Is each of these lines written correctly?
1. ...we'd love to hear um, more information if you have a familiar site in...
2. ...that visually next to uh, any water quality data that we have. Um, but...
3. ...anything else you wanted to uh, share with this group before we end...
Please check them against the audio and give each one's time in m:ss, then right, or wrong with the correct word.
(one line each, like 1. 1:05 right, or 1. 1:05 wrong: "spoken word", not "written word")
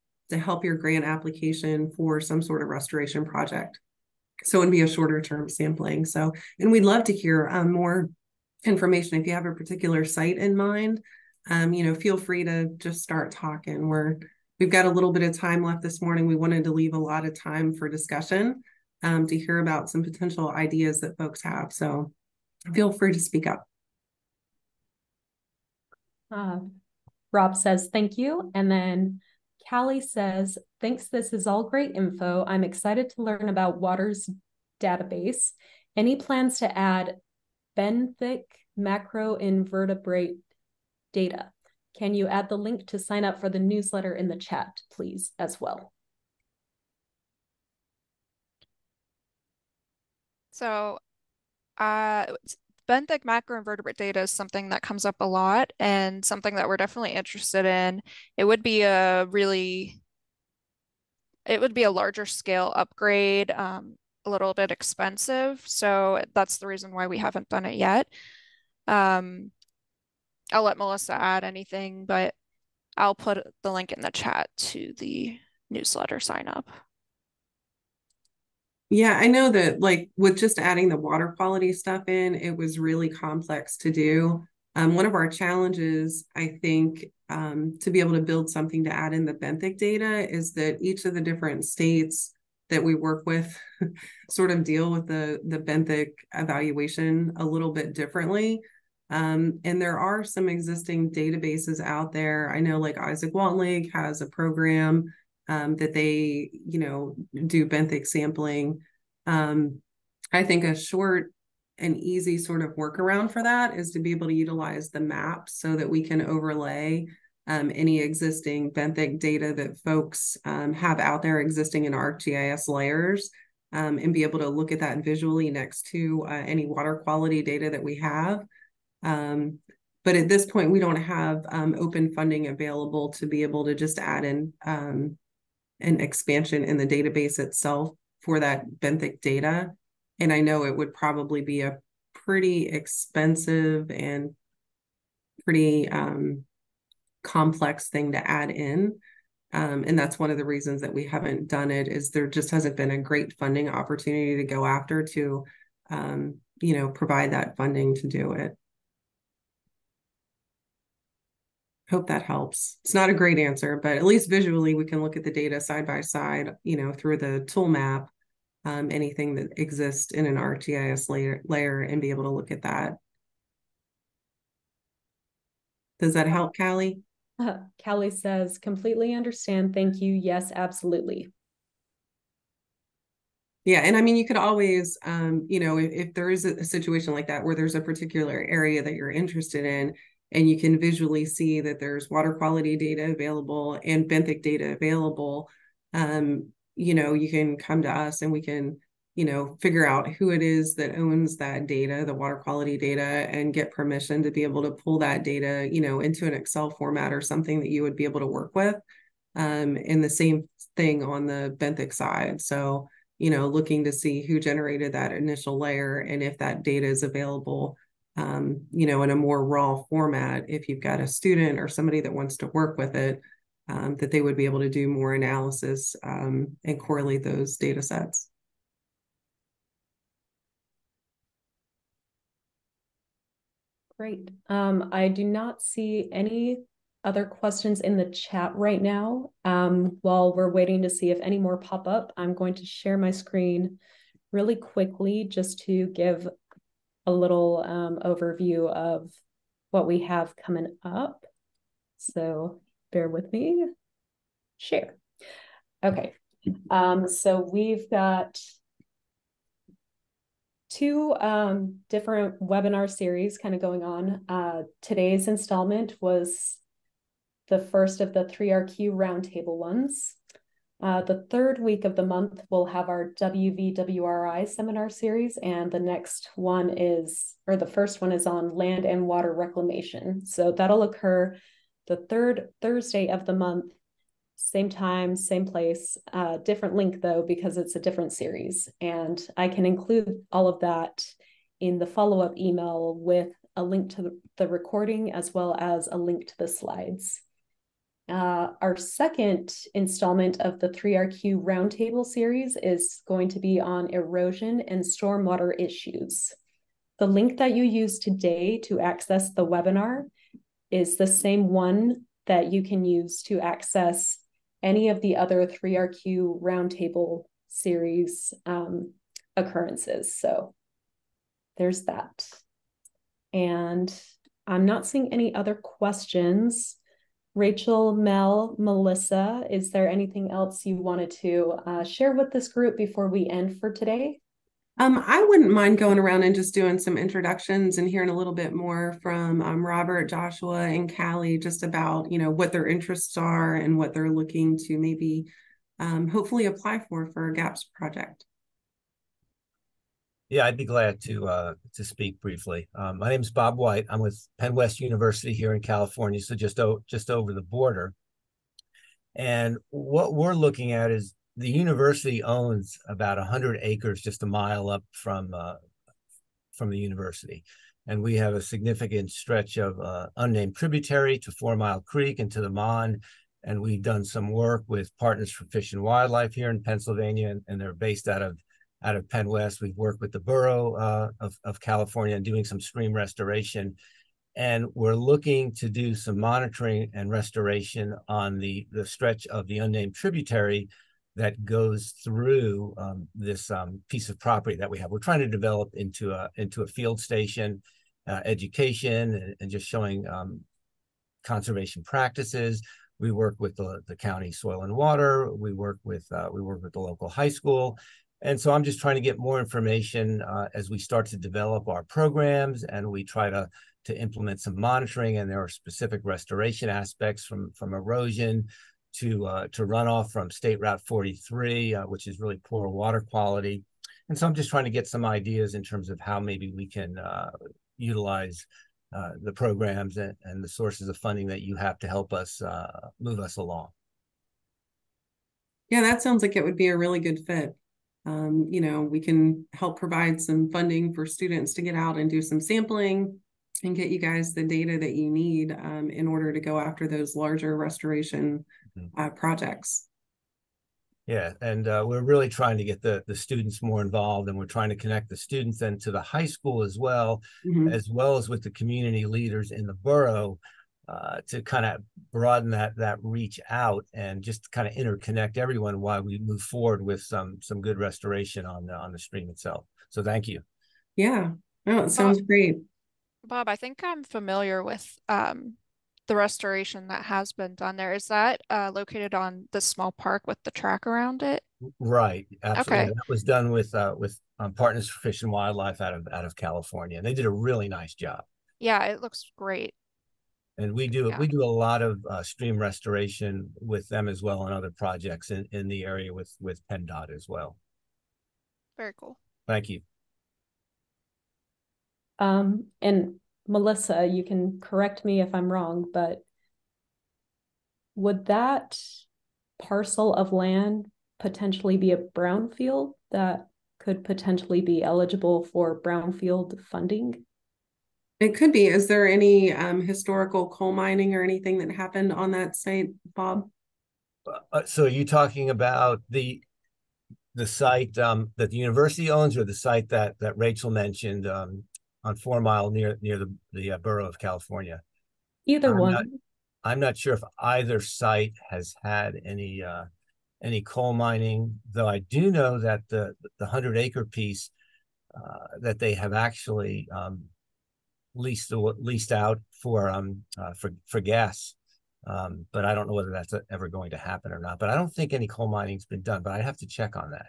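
1. 0:06 wrong: "particular", not "familiar"
2. 2:04 right
3. 5:29 right.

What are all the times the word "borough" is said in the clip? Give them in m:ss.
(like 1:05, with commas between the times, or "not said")
6:20, 7:39, 8:53.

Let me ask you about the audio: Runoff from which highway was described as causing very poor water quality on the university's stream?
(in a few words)
State Route 43.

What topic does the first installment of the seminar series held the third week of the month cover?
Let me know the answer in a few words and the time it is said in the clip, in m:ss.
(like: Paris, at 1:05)
land and water reclamation, at 4:38.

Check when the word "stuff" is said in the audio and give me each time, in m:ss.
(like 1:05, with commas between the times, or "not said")
1:21.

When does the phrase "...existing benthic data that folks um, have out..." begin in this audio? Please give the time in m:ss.
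1:57.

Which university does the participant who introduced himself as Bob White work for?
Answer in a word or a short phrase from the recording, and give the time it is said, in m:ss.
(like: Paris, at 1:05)
Penn West University, at 5:54.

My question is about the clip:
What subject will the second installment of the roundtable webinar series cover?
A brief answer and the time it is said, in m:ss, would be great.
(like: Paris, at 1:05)
erosion and stormwater issues, at 5:03.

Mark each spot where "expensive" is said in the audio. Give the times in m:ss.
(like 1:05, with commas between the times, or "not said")
1:04, 2:22.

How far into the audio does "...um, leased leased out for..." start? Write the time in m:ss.
9:06.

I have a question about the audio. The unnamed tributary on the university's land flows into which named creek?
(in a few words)
Four Mile Creek.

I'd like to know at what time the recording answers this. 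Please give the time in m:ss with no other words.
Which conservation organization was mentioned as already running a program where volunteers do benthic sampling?
1:42.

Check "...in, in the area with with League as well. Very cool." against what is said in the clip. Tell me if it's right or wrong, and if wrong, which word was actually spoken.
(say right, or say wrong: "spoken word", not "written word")
wrong: "PennDOT", not "League".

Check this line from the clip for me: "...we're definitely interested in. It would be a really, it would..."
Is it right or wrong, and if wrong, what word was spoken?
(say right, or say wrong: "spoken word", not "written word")
right.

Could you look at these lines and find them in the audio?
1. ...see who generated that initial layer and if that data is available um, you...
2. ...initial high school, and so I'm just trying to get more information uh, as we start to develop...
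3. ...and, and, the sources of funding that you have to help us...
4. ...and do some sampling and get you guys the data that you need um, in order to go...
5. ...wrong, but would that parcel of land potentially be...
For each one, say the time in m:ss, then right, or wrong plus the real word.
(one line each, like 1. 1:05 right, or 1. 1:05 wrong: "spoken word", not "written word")
1. 3:33 right
2. 6:46 wrong: "local", not "initial"
3. 7:09 right
4. 7:21 right
5. 8:25 right.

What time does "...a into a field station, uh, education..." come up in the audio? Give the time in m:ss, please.
6:36.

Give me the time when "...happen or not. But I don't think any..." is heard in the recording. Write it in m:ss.
9:13.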